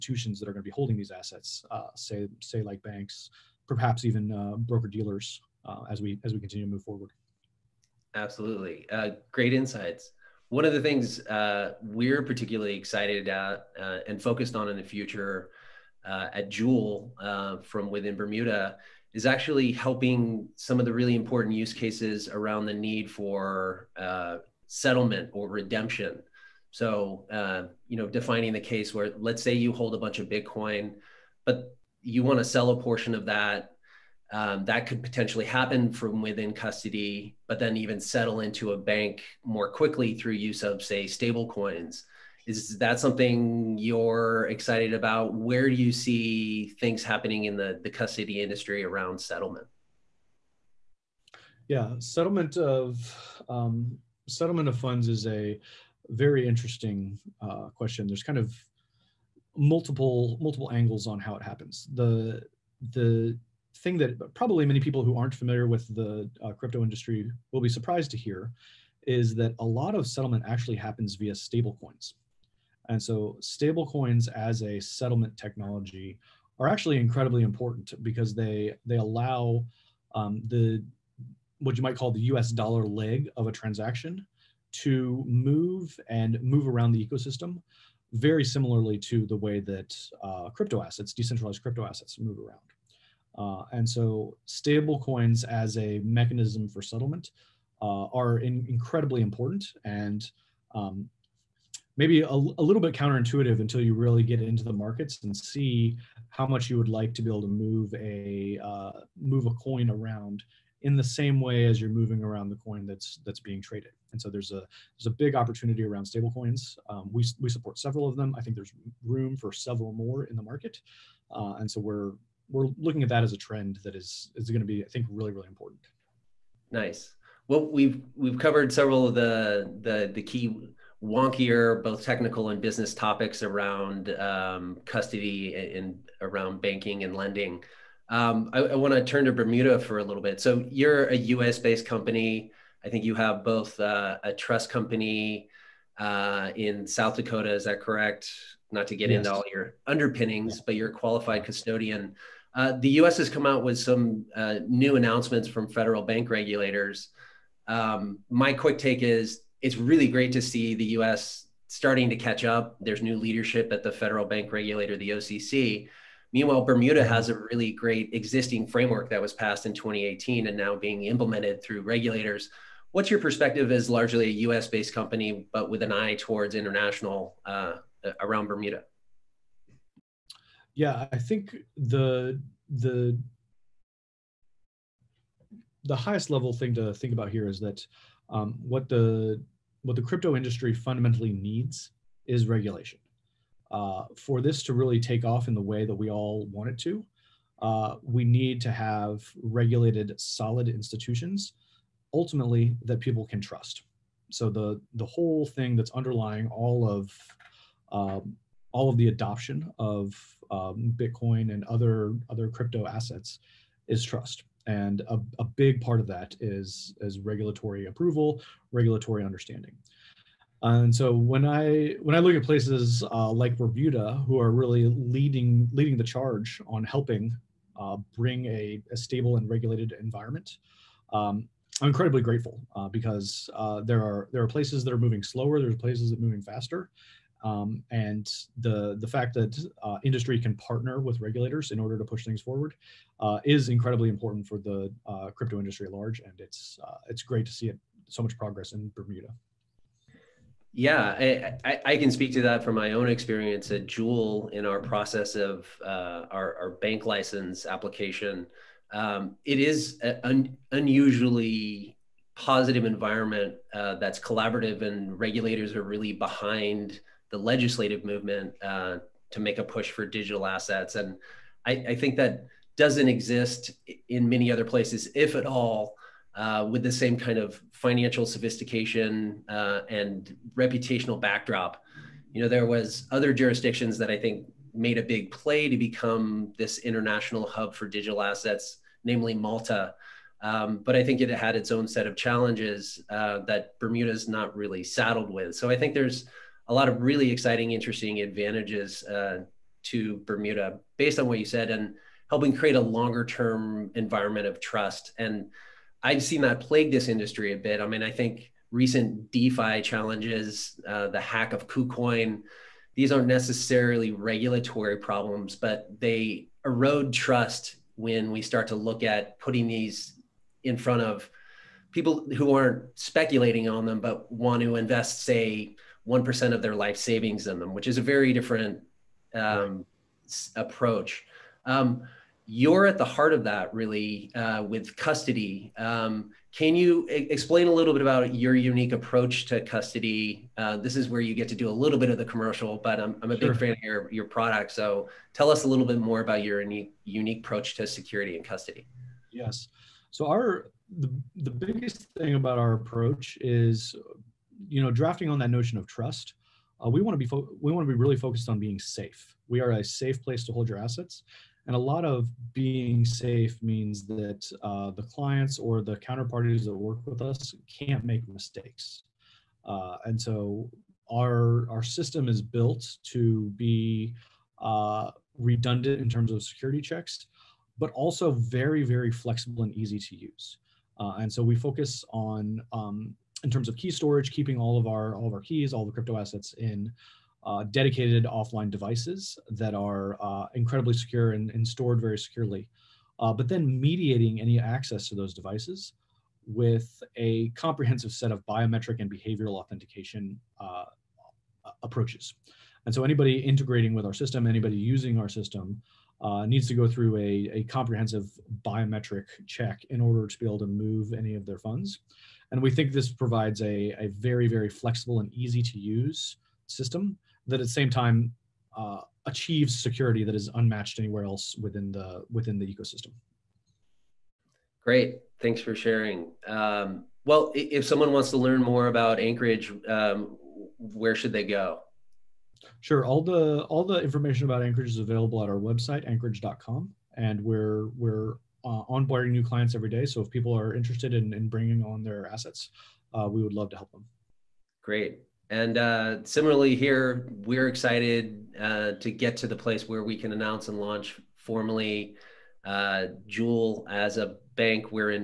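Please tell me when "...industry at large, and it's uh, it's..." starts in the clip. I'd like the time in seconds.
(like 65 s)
245 s.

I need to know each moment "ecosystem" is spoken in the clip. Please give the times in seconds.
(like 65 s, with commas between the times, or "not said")
87 s, 422 s.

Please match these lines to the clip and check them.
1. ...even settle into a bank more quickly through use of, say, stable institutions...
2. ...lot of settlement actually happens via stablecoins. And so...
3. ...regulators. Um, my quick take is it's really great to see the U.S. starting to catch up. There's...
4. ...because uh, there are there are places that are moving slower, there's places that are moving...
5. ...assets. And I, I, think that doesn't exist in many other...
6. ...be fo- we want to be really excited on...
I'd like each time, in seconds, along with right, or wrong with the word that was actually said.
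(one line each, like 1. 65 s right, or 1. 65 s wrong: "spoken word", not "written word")
1. 37 s wrong: "coins", not "institutions"
2. 69 s right
3. 156 s right
4. 232 s right
5. 270 s right
6. 357 s wrong: "focused", not "excited".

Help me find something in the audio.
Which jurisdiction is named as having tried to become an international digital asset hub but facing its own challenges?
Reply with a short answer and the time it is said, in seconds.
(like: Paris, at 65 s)
Malta, at 289 s.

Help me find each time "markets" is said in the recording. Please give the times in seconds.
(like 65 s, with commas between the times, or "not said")
104 s, 120 s.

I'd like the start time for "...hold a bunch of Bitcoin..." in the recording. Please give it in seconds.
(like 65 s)
29 s.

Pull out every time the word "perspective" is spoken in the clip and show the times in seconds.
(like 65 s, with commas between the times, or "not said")
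173 s.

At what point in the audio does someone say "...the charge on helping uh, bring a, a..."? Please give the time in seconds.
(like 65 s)
225 s.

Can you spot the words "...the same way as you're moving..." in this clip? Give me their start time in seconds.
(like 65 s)
110 s.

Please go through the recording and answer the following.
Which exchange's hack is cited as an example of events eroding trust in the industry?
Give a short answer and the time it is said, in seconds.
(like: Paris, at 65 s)
KuCoin, at 311 s.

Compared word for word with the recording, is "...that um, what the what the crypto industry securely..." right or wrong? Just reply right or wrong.
wrong.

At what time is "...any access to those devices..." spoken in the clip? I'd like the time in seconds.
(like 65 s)
394 s.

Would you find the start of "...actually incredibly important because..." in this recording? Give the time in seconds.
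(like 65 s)
76 s.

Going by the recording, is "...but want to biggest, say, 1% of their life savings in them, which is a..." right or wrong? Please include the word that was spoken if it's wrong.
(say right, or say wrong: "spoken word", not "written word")
wrong: "invest", not "biggest".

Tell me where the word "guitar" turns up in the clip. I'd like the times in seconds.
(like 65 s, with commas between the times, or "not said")
not said.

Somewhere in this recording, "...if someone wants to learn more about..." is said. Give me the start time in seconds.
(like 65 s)
427 s.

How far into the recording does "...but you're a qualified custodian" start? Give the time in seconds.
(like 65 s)
150 s.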